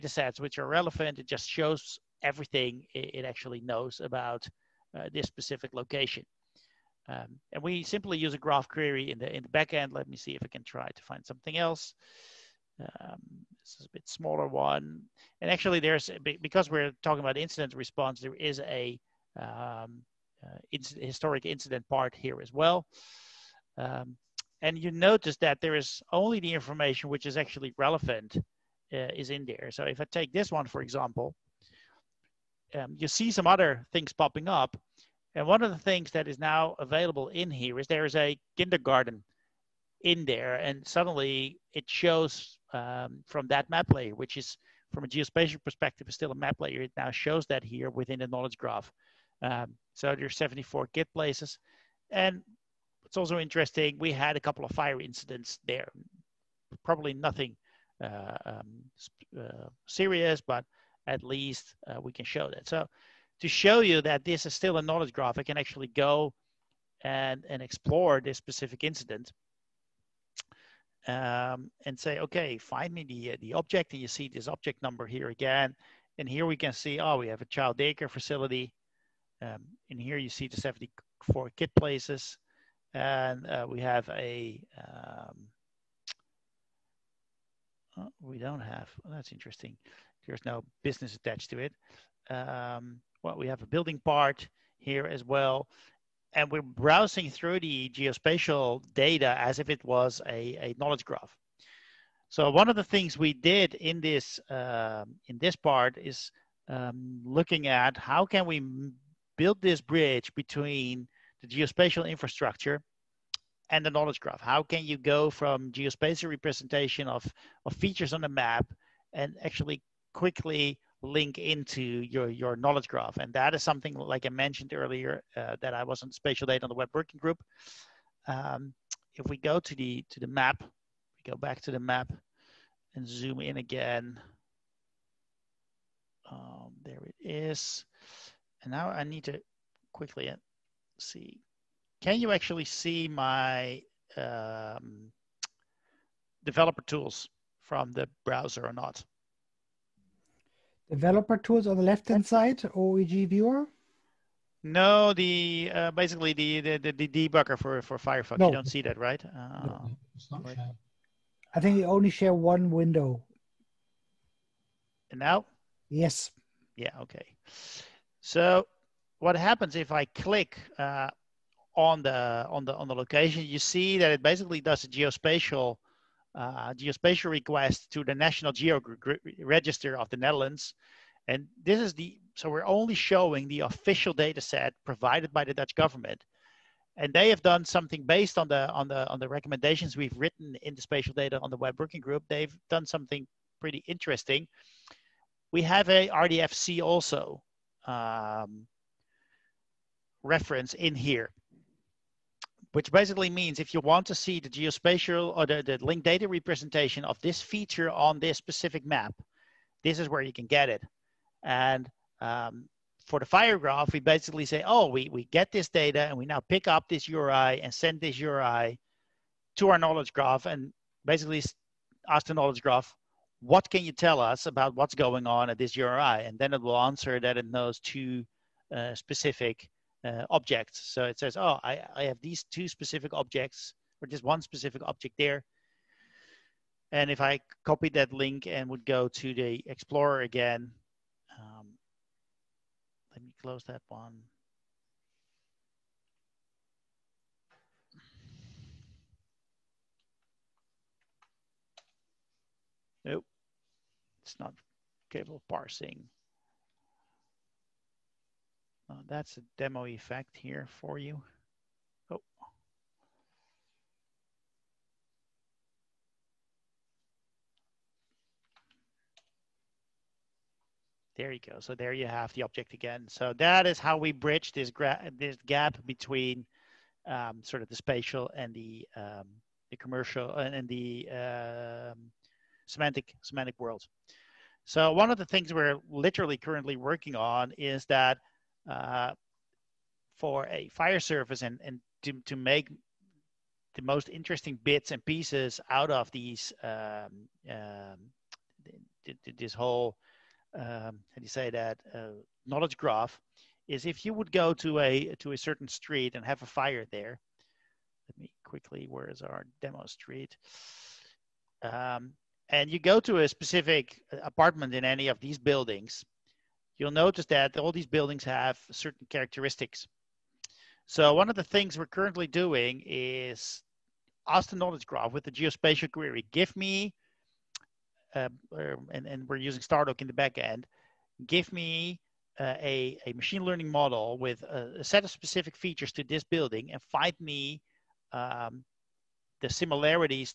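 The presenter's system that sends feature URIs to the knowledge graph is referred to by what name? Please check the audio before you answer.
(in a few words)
fire graph.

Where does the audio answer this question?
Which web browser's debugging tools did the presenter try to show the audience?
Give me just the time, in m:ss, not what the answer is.
2:37.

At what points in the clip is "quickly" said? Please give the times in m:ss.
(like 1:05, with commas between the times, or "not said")
2:00, 2:19, 5:08.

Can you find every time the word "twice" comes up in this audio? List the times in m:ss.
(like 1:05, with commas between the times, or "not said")
not said.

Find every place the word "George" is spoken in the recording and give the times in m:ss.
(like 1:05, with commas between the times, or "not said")
not said.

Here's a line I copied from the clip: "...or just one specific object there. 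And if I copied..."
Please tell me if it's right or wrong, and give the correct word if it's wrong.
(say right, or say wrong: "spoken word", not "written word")
right.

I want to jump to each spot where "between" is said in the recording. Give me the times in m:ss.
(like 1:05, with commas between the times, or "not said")
1:50, 4:35.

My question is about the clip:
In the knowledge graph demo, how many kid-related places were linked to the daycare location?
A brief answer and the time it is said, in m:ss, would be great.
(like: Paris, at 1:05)
74, at 0:50.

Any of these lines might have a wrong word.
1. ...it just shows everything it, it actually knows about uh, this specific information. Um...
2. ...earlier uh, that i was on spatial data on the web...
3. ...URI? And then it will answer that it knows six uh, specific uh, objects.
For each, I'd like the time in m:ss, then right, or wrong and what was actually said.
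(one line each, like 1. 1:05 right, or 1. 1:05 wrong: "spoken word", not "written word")
1. 0:01 wrong: "location", not "information"
2. 2:04 right
3. 3:45 wrong: "two", not "six".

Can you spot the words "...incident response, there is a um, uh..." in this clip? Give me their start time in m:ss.
0:17.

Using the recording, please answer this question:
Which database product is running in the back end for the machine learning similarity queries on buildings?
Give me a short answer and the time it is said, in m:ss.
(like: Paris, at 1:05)
Stardog, at 5:29.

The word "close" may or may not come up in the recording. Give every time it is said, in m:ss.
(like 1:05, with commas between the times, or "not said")
4:03.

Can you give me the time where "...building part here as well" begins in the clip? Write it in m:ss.
1:33.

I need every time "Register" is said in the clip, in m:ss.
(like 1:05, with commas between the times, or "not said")
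2:59.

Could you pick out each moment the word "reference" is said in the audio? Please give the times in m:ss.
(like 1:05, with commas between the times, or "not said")
3:20.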